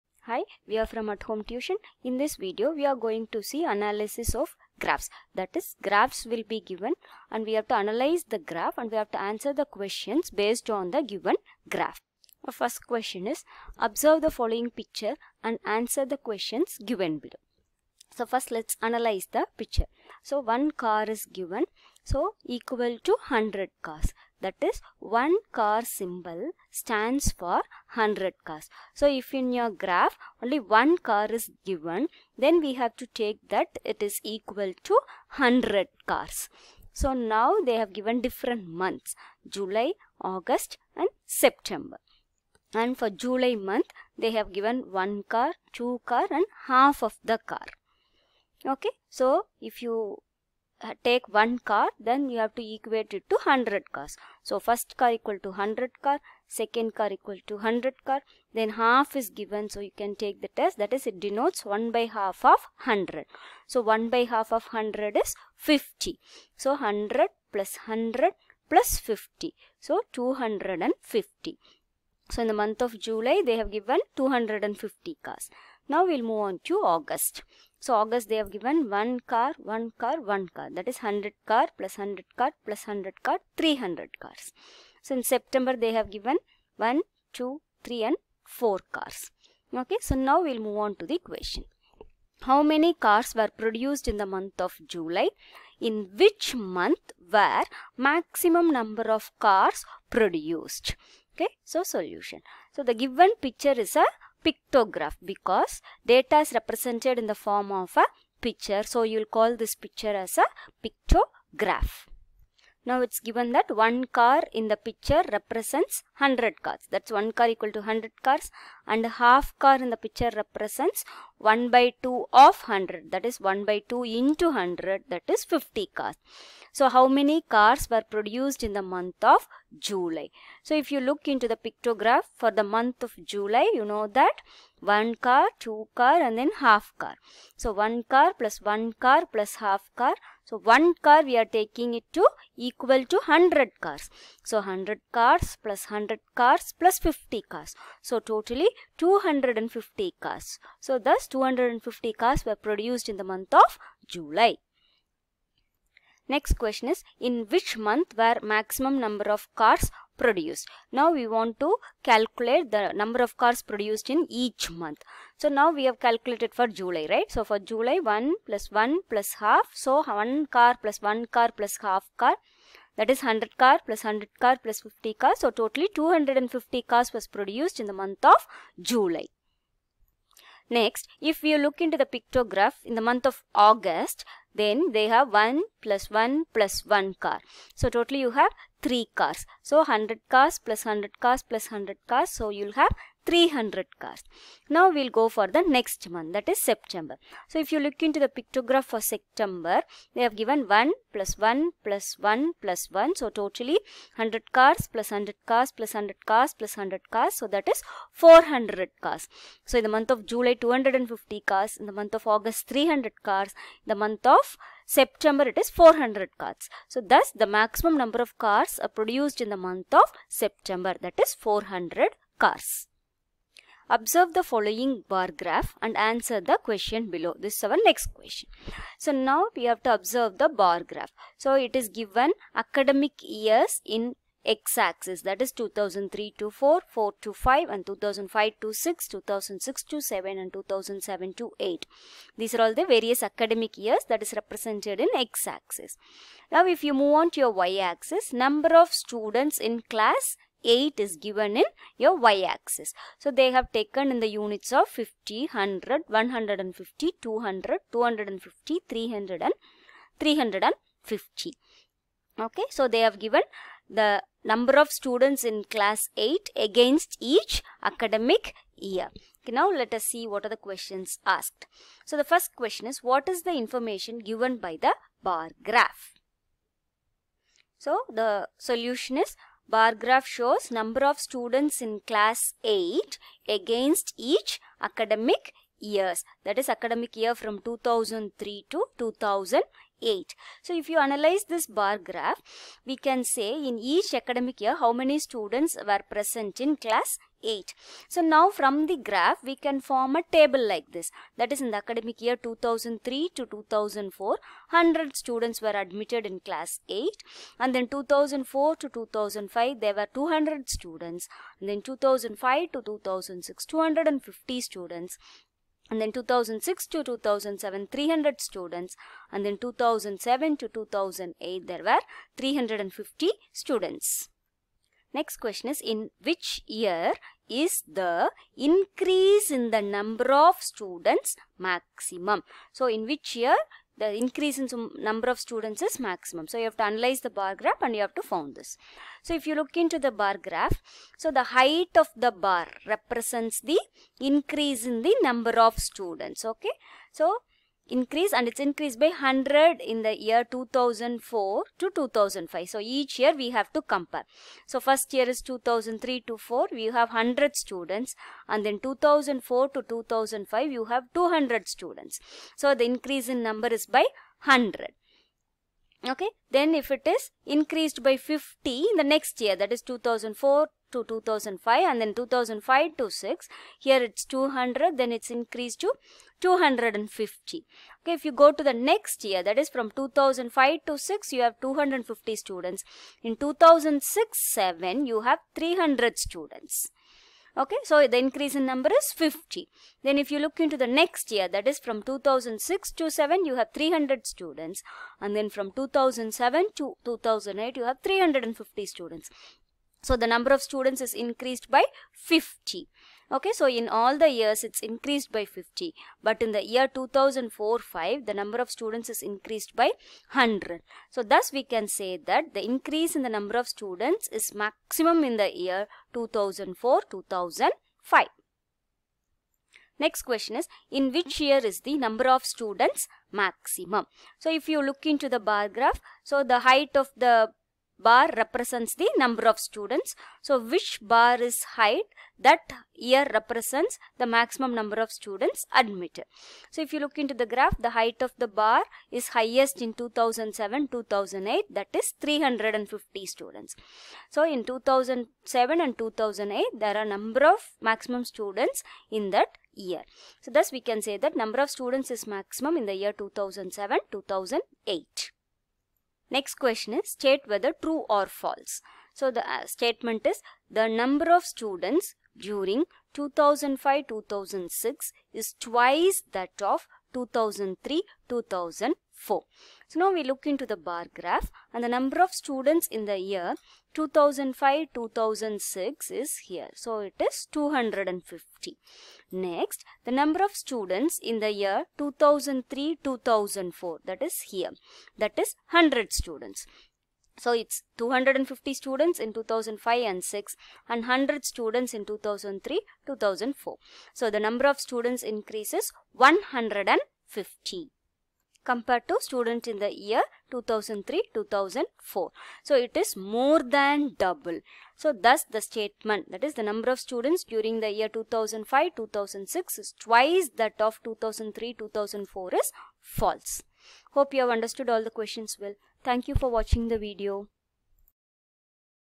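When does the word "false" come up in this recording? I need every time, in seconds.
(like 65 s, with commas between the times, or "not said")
458 s, 513 s.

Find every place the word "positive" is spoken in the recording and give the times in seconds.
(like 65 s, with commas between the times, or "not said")
not said.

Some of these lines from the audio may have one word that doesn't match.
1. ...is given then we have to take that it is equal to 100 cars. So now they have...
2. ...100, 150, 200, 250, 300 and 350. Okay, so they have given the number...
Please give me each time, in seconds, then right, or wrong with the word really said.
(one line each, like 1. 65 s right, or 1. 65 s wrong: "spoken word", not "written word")
1. 31 s right
2. 255 s right.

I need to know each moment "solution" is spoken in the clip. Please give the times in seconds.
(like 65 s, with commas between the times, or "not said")
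101 s, 278 s.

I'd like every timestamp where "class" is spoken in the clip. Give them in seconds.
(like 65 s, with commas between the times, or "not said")
249 s, 265 s, 281 s, 296 s, 306 s.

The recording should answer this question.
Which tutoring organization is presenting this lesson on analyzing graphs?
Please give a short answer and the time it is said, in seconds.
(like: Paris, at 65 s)
At Home Tuition, at 1 s.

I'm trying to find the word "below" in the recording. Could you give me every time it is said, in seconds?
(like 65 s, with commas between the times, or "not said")
17 s, 227 s.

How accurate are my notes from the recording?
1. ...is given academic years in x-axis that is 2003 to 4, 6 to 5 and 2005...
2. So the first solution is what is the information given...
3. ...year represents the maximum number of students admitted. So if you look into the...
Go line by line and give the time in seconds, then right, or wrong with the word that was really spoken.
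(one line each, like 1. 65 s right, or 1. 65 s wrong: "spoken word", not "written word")
1. 231 s wrong: "4", not "6"
2. 272 s wrong: "question", not "solution"
3. 432 s right.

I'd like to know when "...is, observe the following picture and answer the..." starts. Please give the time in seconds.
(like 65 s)
13 s.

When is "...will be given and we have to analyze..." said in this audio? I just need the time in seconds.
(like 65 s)
6 s.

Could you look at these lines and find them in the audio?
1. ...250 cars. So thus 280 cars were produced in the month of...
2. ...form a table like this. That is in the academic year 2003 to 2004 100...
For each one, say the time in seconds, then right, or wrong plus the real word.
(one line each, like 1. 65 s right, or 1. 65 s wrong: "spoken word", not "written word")
1. 148 s wrong: "250", not "280"
2. 299 s right.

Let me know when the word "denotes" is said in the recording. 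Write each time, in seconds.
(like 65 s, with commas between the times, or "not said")
61 s.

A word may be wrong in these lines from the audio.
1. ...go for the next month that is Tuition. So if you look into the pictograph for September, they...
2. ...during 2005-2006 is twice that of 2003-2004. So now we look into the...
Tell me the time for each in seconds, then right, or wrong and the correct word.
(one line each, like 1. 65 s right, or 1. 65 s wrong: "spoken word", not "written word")
1. 195 s wrong: "September", not "Tuition"
2. 462 s right.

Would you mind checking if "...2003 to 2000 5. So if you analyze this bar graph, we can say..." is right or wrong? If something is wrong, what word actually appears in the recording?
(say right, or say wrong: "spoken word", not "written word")
wrong: "8", not "5".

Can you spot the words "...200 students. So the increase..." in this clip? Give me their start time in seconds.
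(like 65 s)
361 s.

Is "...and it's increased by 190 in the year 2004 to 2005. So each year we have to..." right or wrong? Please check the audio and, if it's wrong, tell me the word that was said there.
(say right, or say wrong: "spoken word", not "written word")
wrong: "100", not "190".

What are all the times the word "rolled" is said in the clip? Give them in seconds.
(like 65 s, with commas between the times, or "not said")
not said.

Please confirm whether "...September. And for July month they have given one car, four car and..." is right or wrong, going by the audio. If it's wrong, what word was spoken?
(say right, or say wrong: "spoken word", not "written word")
wrong: "two", not "four".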